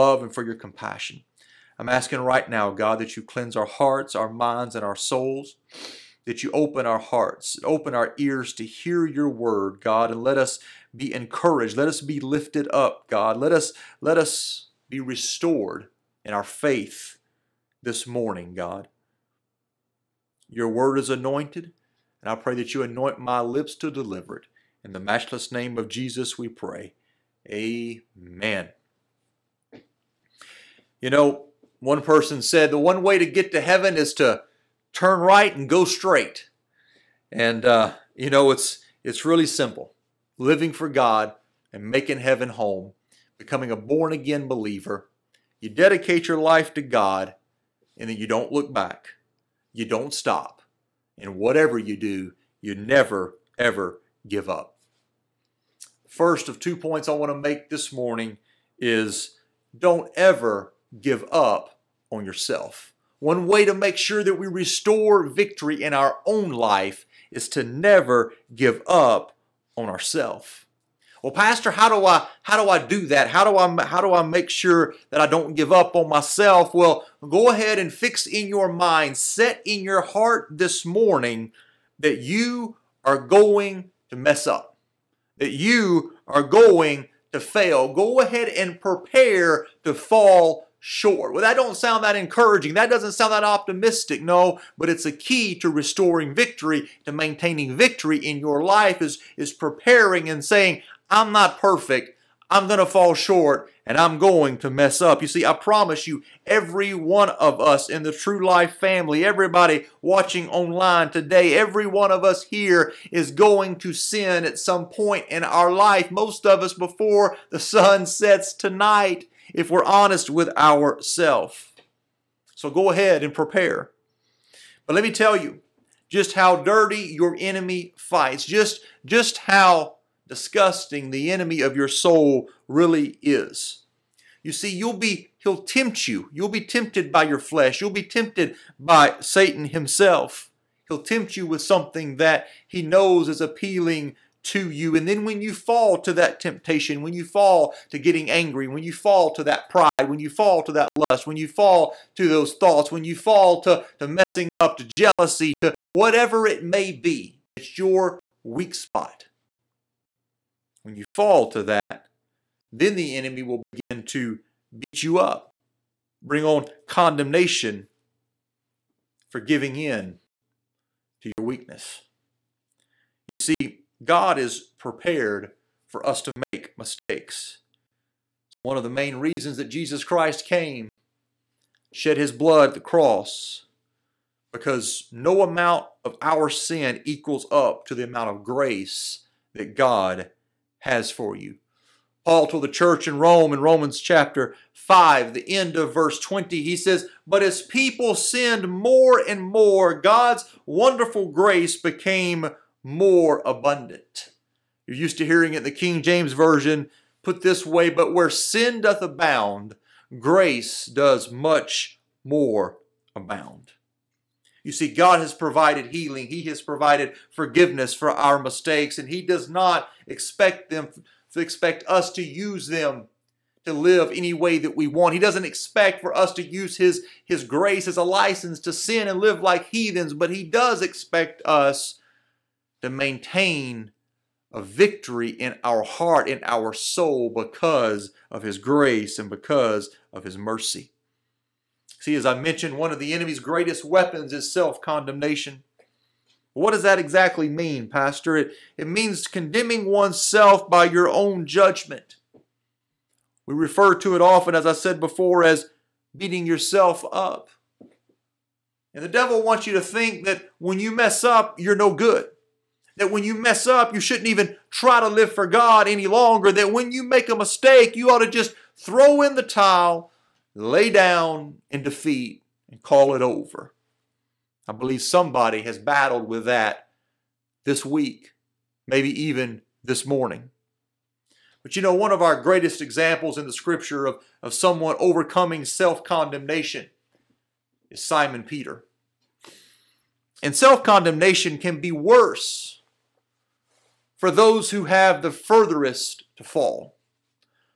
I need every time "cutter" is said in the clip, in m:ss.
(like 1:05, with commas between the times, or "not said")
not said.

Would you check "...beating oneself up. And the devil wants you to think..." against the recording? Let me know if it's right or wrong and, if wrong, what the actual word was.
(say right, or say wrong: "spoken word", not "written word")
wrong: "yourself", not "oneself".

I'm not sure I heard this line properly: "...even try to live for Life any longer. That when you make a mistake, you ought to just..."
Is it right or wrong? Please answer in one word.
wrong.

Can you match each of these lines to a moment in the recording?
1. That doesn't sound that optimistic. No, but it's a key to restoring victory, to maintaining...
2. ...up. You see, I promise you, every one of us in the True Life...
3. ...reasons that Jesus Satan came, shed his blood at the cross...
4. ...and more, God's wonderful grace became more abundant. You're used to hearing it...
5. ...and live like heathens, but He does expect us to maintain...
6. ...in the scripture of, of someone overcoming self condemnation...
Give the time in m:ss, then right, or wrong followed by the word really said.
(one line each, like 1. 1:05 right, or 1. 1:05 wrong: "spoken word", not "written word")
1. 1:32 right
2. 1:45 right
3. 2:59 wrong: "Christ", not "Satan"
4. 3:19 right
5. 3:49 right
6. 4:43 right.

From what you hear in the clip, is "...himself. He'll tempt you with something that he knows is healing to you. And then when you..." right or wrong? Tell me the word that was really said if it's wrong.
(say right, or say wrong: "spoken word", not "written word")
wrong: "appealing", not "healing".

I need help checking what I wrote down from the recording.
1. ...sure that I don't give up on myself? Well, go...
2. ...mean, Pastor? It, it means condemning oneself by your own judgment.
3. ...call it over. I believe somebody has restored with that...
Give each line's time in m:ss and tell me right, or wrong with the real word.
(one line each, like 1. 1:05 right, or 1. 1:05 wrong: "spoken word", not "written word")
1. 1:14 right
2. 4:07 right
3. 4:32 wrong: "battled", not "restored".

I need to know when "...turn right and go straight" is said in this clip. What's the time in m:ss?
0:34.